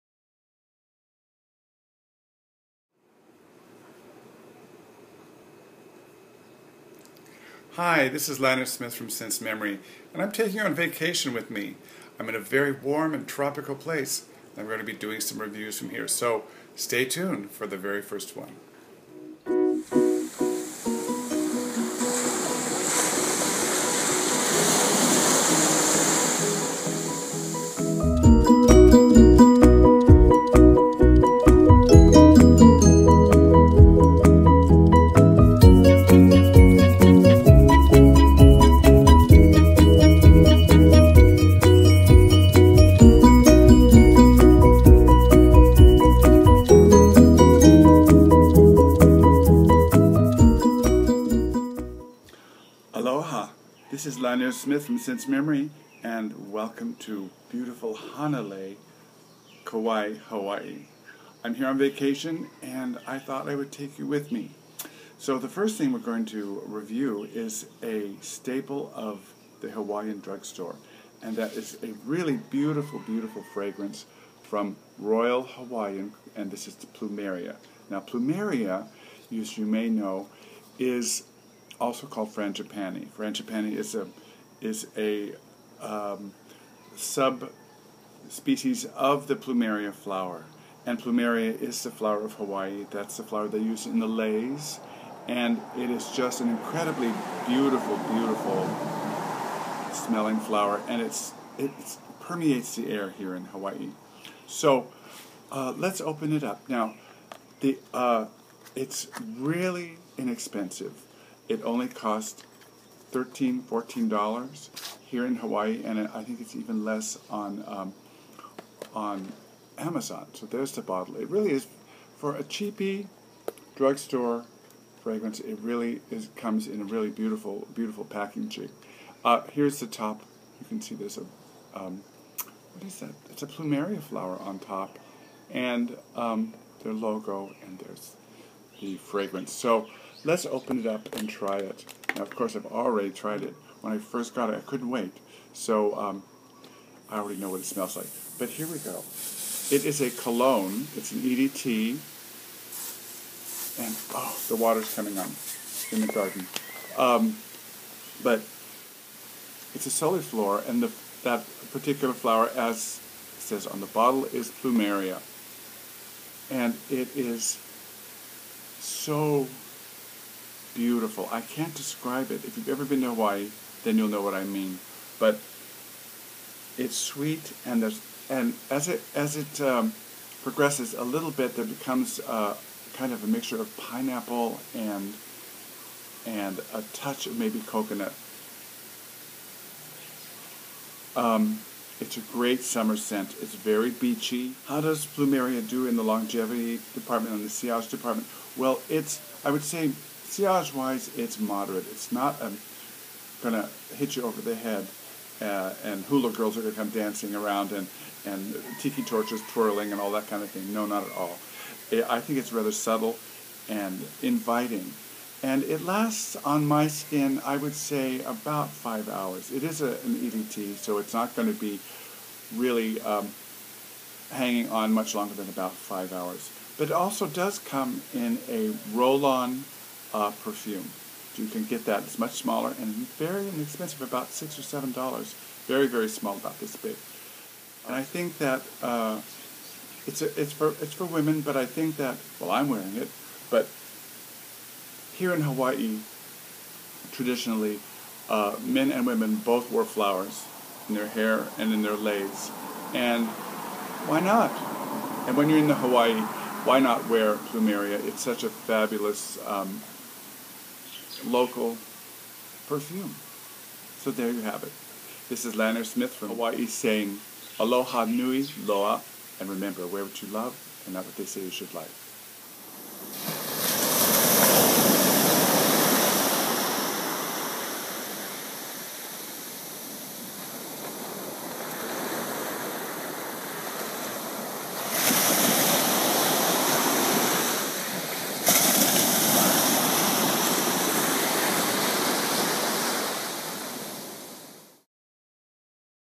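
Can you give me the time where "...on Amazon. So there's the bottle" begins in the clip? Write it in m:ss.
1:58.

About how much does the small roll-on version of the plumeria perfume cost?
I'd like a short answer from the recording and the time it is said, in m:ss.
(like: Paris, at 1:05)
$6 or $7, at 3:54.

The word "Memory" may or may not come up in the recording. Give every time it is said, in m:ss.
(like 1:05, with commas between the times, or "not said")
0:09, 0:55.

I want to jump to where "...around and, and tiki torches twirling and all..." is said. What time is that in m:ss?
3:27.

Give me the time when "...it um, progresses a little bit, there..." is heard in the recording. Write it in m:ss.
2:59.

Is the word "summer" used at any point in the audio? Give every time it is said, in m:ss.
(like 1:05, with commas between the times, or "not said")
3:12.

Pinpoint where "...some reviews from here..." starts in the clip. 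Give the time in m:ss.
0:15.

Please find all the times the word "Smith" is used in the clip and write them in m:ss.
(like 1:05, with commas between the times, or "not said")
0:08, 0:54, 4:25.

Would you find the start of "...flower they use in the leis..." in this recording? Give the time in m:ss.
1:33.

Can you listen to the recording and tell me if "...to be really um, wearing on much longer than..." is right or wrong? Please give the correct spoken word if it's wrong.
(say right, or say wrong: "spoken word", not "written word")
wrong: "hanging", not "wearing".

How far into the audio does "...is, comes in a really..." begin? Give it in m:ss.
2:06.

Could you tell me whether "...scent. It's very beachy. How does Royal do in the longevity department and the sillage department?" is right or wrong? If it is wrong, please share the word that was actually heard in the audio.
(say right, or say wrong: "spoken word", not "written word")
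wrong: "Plumeria", not "Royal".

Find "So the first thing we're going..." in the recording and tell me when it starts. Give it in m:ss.
1:05.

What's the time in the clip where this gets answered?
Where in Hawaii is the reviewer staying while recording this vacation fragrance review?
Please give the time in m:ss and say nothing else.
0:57.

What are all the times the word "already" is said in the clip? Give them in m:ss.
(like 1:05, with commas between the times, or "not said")
2:22, 2:27.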